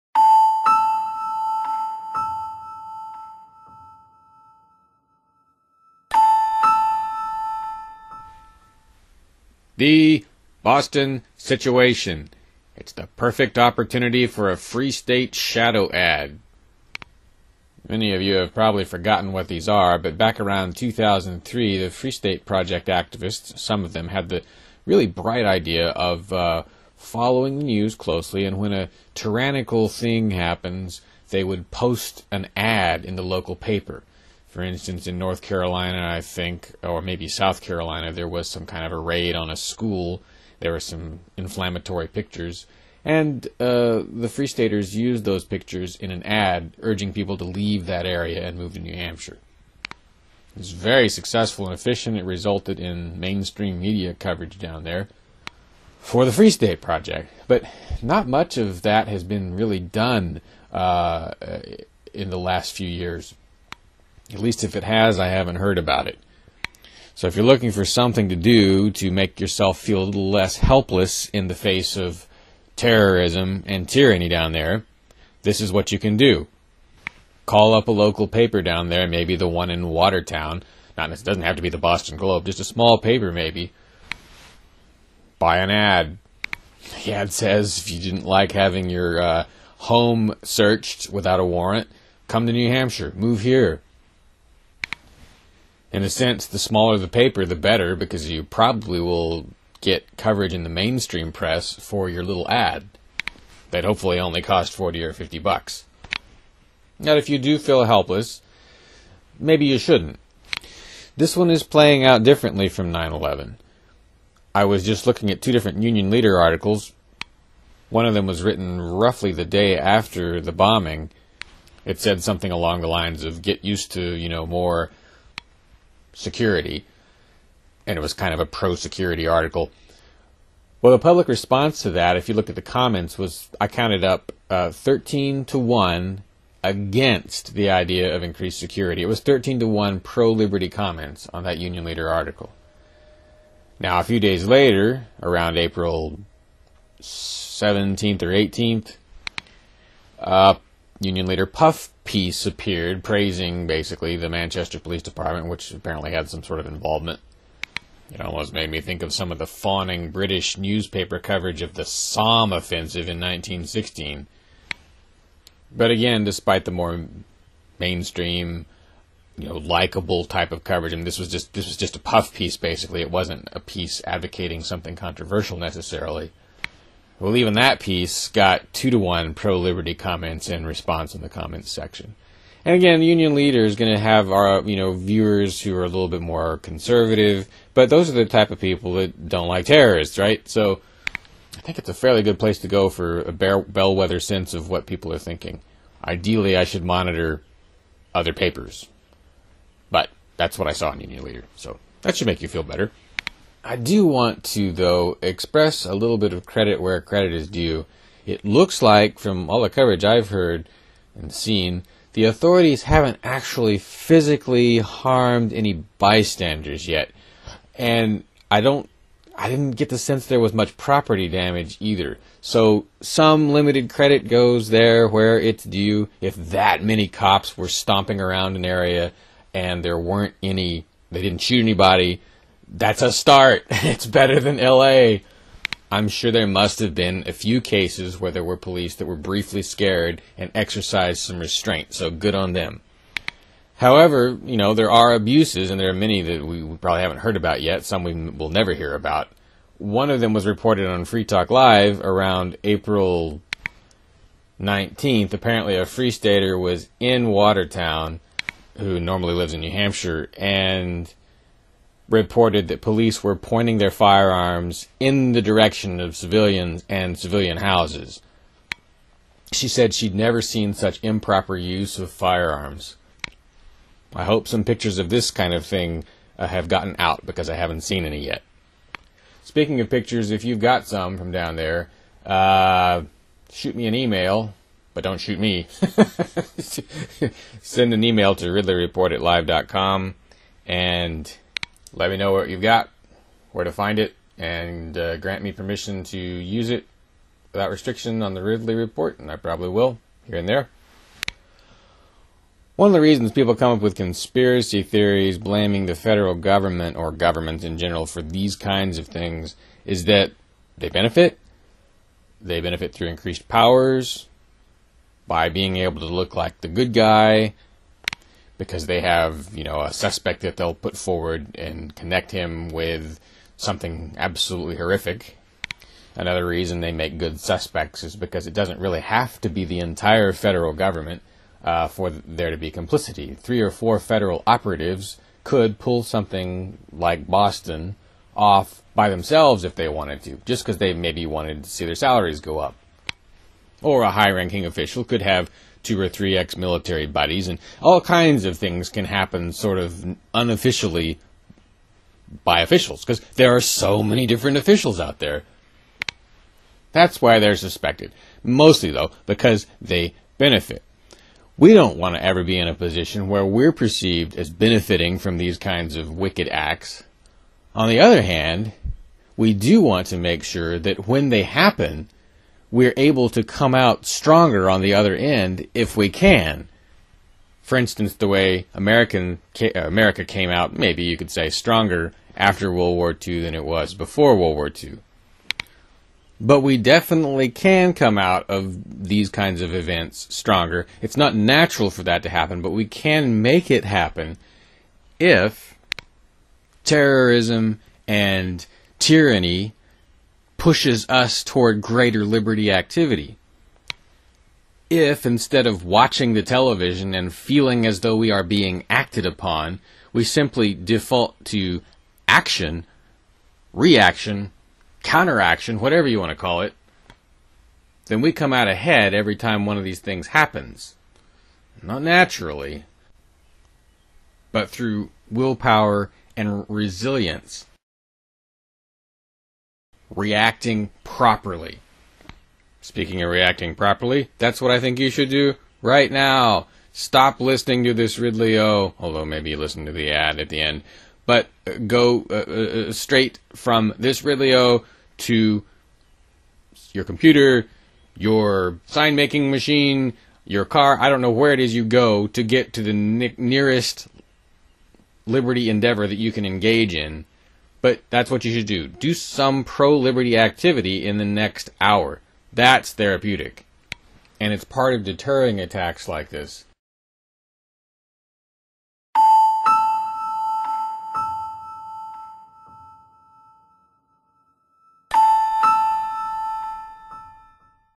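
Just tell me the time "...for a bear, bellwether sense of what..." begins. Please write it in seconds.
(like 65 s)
192 s.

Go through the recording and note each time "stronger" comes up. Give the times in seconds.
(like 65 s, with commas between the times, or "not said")
374 s, 381 s, 390 s.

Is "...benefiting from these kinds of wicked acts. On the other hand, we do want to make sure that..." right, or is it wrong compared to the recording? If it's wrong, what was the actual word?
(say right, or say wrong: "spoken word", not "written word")
right.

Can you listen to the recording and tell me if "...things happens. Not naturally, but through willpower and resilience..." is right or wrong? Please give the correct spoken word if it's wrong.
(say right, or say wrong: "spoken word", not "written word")
right.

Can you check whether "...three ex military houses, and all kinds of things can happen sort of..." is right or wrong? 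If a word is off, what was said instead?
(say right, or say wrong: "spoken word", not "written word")
wrong: "buddies", not "houses".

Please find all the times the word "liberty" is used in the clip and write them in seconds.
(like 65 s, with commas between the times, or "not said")
140 s, 179 s, 402 s, 455 s, 459 s.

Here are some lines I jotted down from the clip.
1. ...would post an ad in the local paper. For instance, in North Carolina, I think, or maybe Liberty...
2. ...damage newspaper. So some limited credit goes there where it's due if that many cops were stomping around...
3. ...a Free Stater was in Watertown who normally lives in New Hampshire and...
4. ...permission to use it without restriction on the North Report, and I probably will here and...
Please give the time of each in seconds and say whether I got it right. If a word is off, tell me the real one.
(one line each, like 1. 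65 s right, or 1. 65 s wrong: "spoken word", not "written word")
1. 31 s wrong: "South", not "Liberty"
2. 221 s wrong: "either", not "newspaper"
3. 255 s right
4. 295 s wrong: "Ridley", not "North".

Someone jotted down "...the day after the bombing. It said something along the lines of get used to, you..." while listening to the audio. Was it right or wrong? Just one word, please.
right.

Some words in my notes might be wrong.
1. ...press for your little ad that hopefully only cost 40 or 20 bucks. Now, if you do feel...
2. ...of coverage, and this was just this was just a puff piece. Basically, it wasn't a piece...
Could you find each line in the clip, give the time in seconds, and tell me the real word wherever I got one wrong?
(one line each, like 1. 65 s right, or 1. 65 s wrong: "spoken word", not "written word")
1. 101 s wrong: "50", not "20"
2. 170 s right.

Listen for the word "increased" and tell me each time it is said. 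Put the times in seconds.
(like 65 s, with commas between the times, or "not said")
138 s, 313 s.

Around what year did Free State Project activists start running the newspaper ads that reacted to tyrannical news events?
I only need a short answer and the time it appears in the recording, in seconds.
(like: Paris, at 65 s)
2003, at 20 s.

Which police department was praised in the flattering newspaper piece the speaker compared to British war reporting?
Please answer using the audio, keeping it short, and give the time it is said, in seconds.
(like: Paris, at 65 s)
Manchester Police Department, at 154 s.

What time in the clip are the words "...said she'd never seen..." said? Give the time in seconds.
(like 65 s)
269 s.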